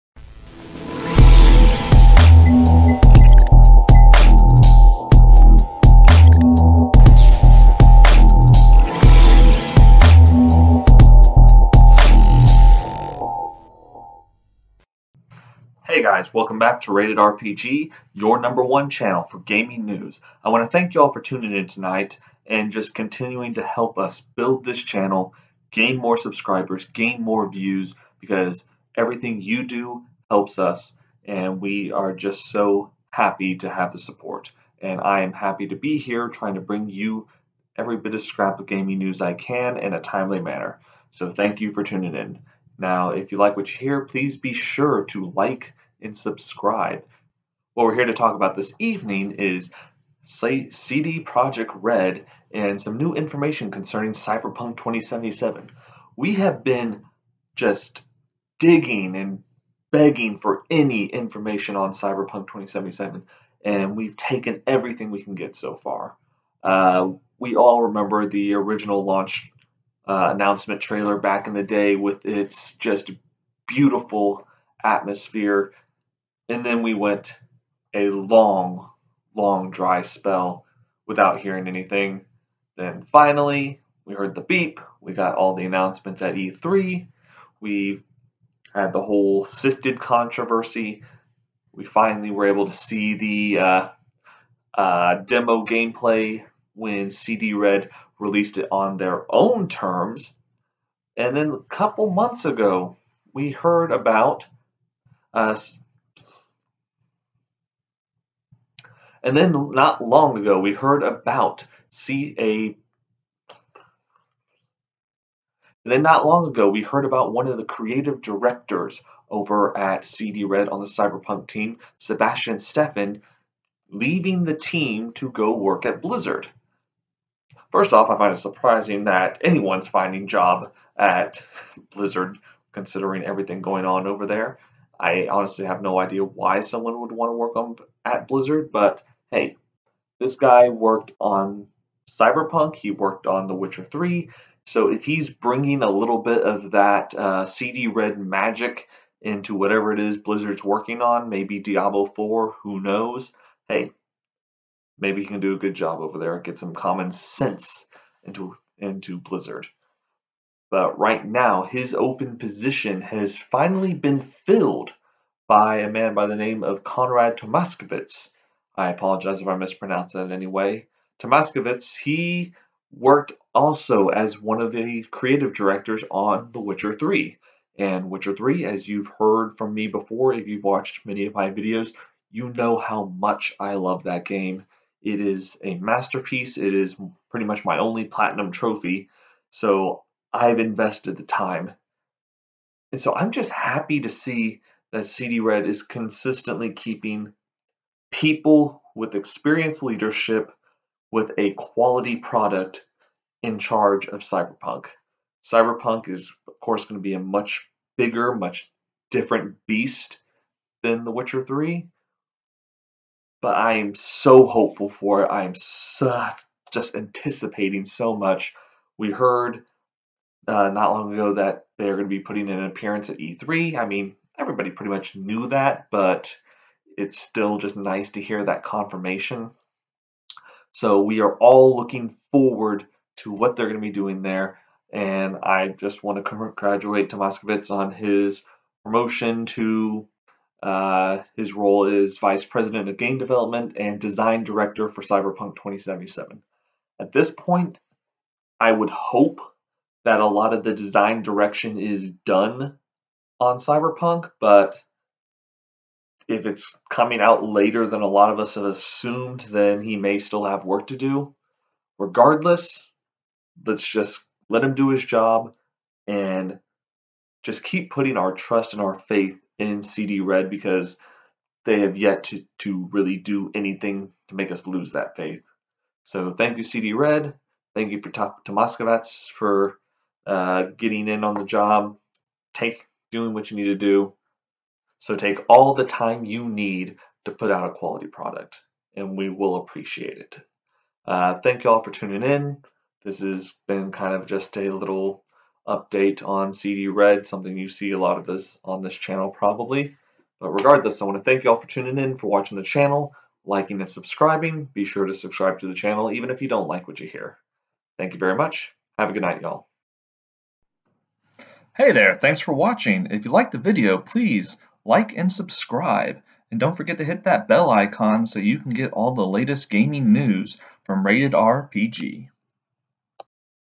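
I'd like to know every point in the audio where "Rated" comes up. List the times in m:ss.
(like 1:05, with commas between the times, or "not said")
0:16, 5:21.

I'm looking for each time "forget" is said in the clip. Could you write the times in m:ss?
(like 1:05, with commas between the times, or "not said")
5:16.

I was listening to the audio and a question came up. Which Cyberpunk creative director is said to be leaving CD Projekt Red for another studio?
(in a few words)
Sebastian Stefan.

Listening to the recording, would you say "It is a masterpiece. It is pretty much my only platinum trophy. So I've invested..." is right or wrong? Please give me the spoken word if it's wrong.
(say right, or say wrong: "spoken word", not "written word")
right.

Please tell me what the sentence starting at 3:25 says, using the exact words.
Cyberpunk is, of course, going to be a much bigger, much different beast than The Witcher 3.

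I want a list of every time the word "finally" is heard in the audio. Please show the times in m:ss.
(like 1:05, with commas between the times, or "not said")
1:23, 1:31, 2:43.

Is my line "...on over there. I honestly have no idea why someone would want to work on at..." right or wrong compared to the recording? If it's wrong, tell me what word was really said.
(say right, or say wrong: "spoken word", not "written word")
right.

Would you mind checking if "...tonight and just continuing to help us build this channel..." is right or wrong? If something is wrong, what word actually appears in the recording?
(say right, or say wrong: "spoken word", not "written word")
right.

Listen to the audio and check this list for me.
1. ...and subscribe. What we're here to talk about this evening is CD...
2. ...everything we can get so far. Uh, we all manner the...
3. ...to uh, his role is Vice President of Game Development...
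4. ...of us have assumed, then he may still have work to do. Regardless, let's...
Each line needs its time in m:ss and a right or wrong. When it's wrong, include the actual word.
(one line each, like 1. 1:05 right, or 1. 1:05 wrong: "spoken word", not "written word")
1. 0:46 right
2. 1:04 wrong: "remember", not "manner"
3. 3:59 right
4. 4:18 right.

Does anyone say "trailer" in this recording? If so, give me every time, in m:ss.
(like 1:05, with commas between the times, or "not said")
1:10.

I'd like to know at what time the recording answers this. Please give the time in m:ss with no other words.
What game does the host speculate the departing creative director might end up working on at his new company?
2:31.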